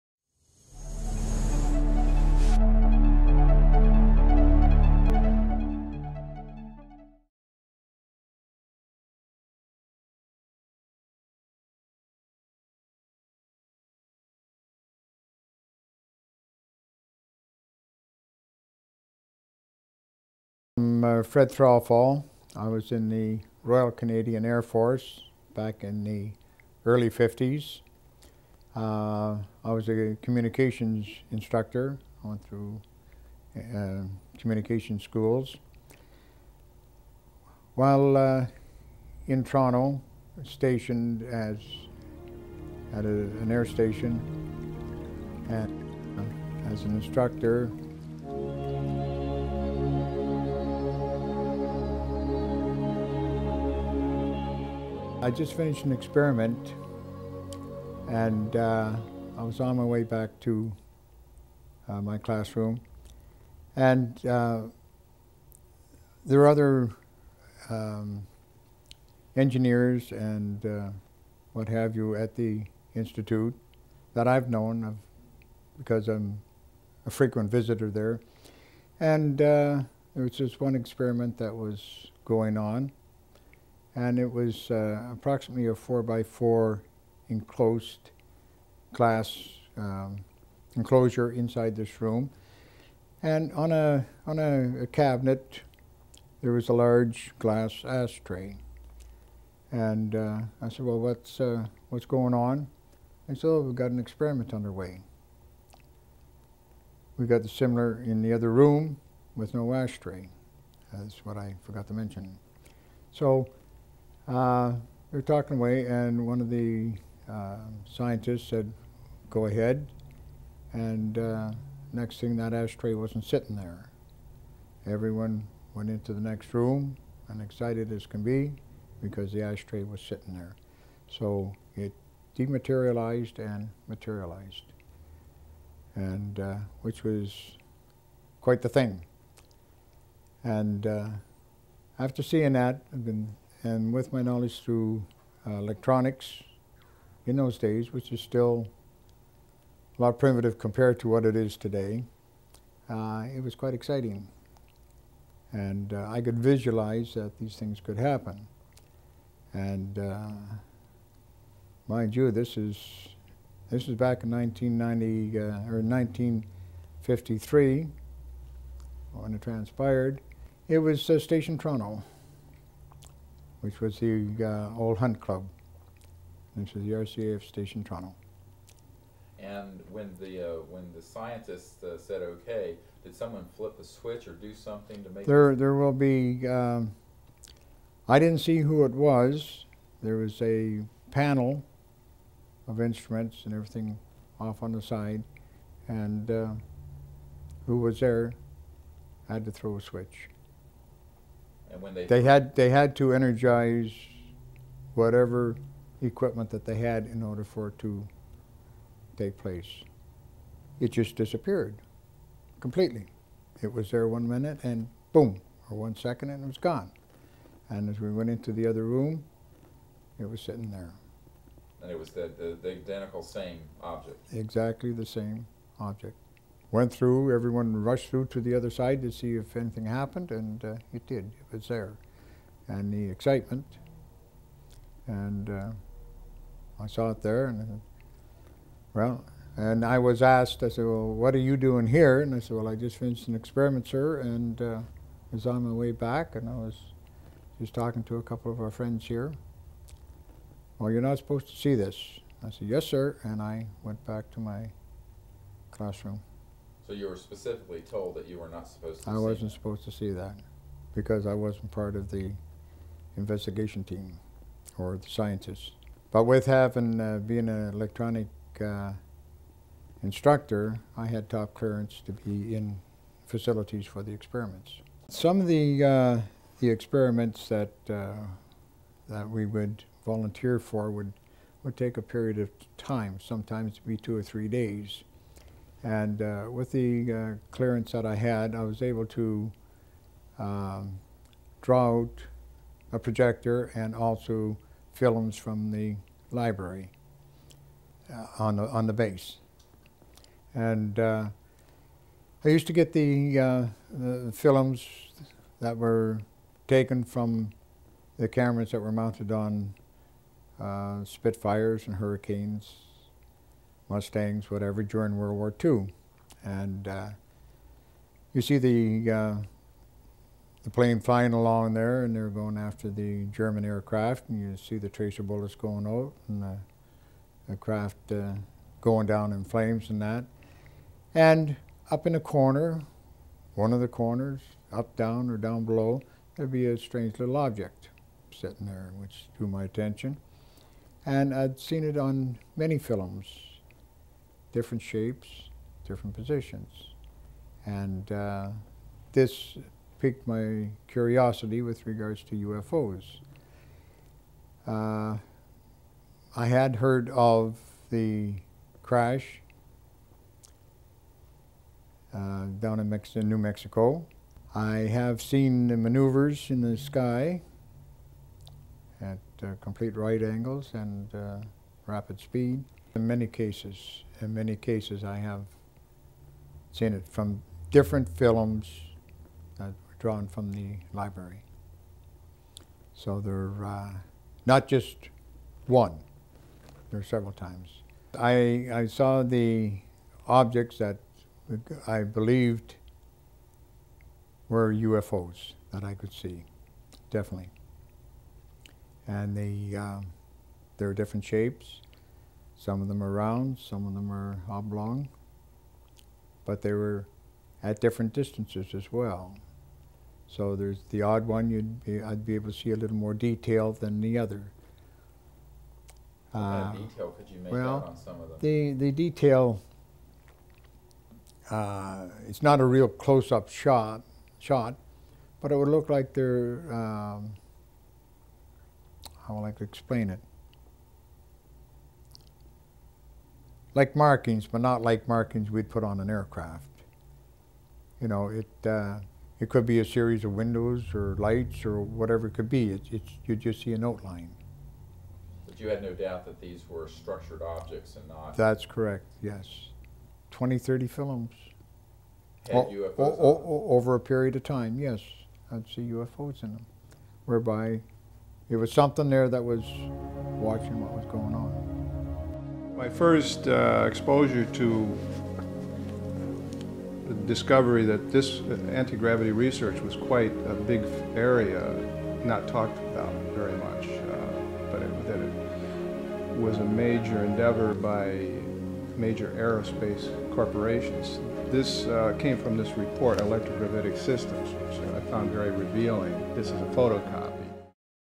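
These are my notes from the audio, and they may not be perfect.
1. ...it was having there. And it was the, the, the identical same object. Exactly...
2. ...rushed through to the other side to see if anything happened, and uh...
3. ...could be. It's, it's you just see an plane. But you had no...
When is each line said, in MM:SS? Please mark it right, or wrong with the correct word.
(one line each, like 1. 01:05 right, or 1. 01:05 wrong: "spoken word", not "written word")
1. 03:40 wrong: "sitting", not "having"
2. 03:47 right
3. 07:22 wrong: "outline", not "plane".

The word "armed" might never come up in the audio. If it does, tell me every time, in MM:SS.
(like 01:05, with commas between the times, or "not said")
not said.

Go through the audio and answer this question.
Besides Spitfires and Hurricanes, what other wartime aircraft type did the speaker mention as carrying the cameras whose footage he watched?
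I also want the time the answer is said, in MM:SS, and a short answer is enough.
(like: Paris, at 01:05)
Mustangs, at 05:13.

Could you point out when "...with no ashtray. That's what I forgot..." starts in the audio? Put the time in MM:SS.
01:49.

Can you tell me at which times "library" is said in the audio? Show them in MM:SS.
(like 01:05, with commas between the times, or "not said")
04:56, 06:20.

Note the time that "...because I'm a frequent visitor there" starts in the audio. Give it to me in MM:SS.
01:15.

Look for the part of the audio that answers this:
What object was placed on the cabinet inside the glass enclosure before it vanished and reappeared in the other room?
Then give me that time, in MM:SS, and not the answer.
01:37.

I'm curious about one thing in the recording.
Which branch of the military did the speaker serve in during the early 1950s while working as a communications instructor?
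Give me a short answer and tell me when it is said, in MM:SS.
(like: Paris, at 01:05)
Royal Canadian Air Force, at 00:23.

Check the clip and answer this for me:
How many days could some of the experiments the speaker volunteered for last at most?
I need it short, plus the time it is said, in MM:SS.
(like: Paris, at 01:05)
3, at 04:44.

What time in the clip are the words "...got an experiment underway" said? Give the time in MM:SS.
01:43.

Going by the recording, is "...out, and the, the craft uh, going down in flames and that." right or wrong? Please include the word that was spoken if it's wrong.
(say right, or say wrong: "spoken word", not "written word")
right.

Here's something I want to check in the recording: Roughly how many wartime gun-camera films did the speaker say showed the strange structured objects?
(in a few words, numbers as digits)
20 to 30.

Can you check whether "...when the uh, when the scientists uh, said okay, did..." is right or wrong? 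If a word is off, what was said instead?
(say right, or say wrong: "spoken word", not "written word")
right.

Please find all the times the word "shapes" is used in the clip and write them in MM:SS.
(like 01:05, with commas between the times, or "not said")
05:44, 06:41.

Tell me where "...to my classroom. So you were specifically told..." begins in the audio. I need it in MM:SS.
04:14.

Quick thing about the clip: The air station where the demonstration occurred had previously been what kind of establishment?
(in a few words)
Hunt Club.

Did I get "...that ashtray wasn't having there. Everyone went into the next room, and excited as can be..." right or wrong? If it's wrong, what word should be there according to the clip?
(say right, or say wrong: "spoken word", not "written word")
wrong: "sitting", not "having".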